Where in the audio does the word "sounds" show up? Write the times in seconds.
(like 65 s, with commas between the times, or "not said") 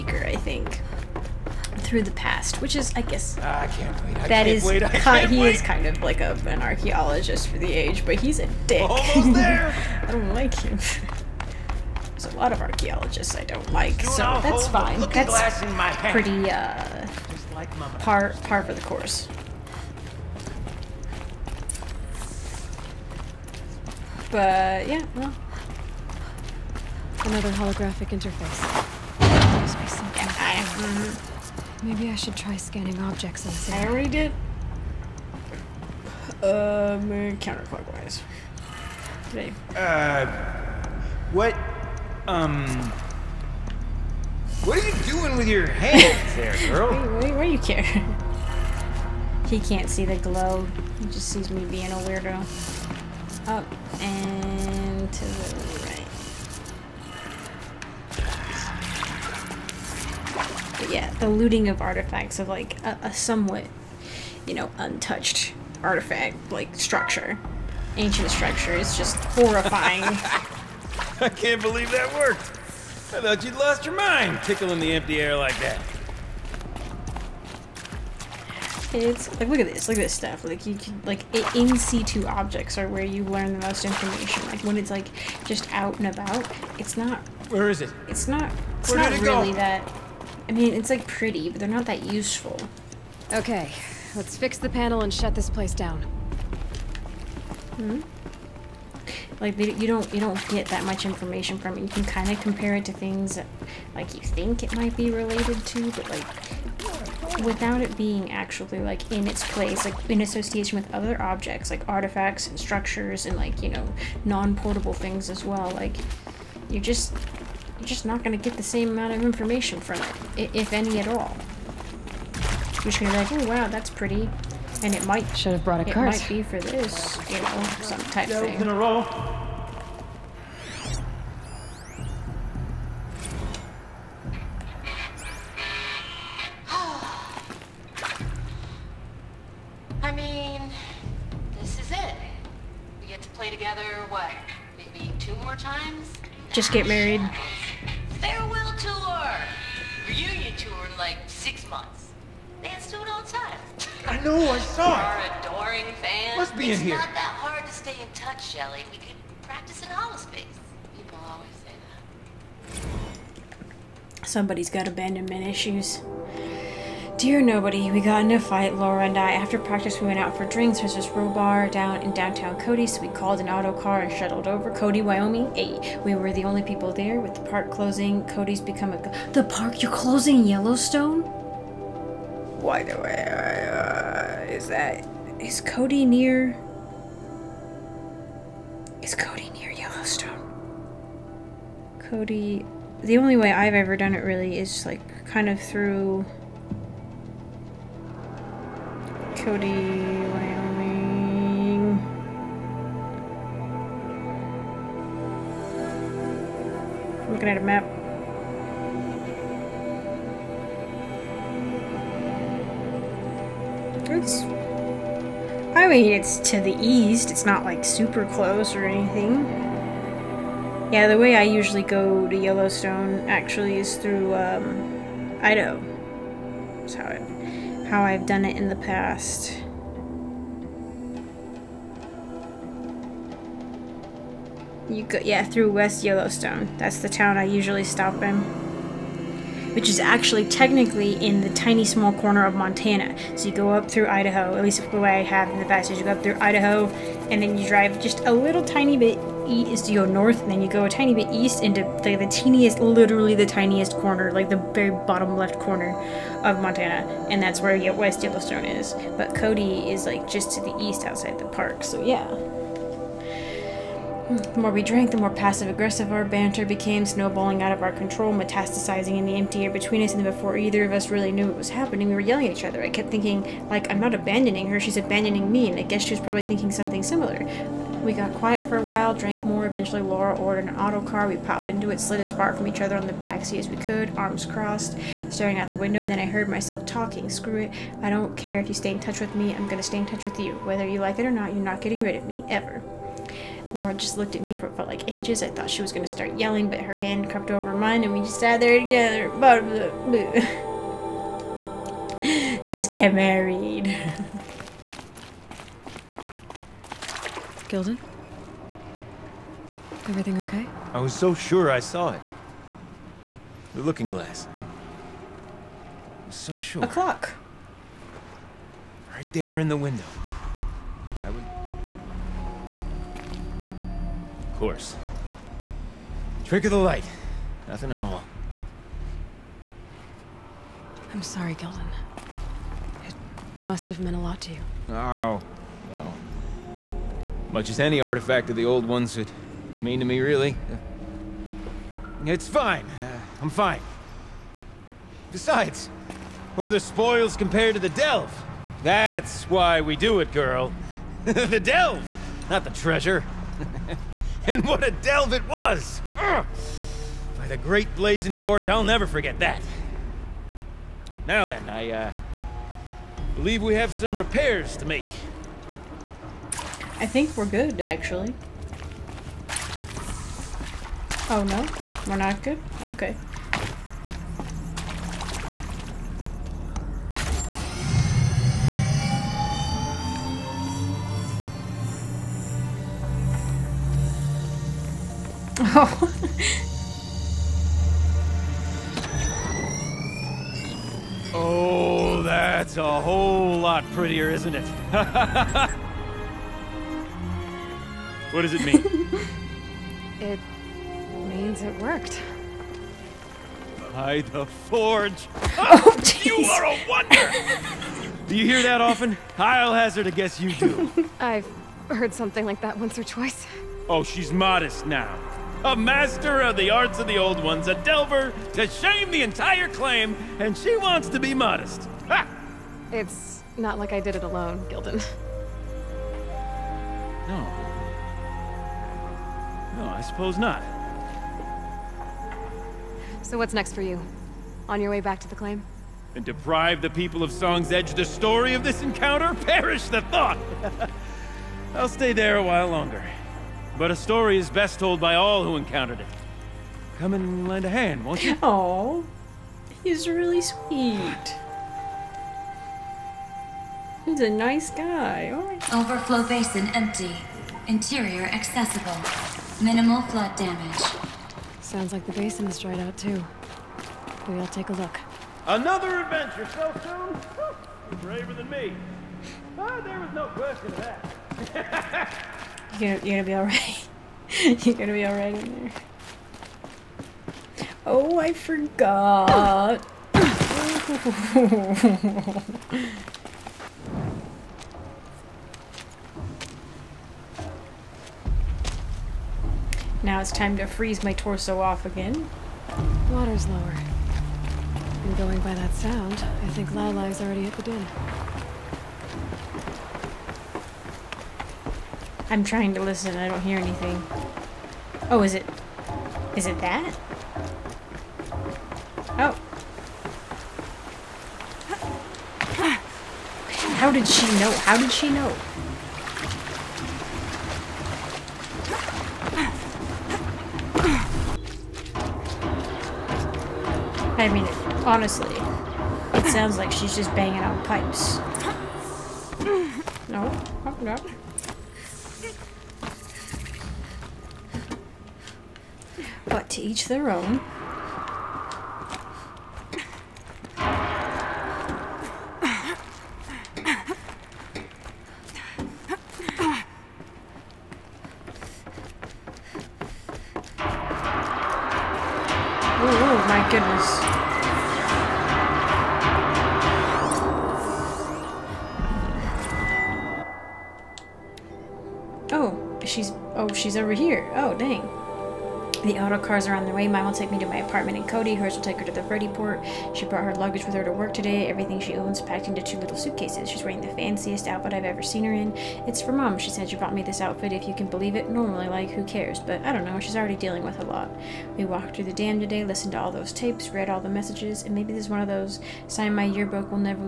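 461 s, 495 s, 526 s.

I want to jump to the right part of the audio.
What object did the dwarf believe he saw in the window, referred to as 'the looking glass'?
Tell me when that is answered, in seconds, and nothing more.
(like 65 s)
316 s.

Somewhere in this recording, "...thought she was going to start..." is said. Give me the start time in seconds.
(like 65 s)
295 s.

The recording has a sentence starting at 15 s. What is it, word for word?
That's pretty uh, par par for the course.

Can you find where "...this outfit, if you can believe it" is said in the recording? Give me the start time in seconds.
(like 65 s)
577 s.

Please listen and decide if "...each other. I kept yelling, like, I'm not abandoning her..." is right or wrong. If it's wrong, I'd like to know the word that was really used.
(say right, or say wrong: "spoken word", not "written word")
wrong: "thinking", not "yelling".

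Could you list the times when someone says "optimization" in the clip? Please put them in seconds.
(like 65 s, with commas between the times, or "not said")
not said.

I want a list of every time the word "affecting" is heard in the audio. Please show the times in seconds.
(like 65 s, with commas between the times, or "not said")
not said.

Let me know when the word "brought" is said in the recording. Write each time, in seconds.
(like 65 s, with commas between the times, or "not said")
125 s, 570 s.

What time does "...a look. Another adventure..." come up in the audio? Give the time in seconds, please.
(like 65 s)
464 s.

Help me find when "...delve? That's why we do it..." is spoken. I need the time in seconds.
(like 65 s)
347 s.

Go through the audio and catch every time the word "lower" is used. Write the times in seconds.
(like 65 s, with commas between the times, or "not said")
493 s.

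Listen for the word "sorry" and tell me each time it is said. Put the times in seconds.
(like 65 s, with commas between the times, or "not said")
331 s.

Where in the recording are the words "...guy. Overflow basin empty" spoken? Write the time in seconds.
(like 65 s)
454 s.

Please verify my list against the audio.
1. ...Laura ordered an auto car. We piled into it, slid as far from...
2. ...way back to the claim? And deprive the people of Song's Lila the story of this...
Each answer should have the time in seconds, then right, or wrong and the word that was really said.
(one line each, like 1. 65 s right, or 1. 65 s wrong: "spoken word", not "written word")
1. 280 s right
2. 434 s wrong: "Edge", not "Lila".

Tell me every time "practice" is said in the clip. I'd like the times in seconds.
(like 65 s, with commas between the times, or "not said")
159 s, 169 s.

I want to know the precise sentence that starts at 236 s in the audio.
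That's the town I usually stop in.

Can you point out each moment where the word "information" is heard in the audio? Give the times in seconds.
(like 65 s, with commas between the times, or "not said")
83 s, 101 s, 119 s.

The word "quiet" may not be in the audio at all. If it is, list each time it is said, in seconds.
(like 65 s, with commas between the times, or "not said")
278 s.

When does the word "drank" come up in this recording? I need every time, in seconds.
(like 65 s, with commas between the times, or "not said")
264 s, 279 s.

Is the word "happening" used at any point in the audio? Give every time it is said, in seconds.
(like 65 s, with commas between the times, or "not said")
271 s.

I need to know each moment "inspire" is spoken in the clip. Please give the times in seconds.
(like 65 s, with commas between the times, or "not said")
not said.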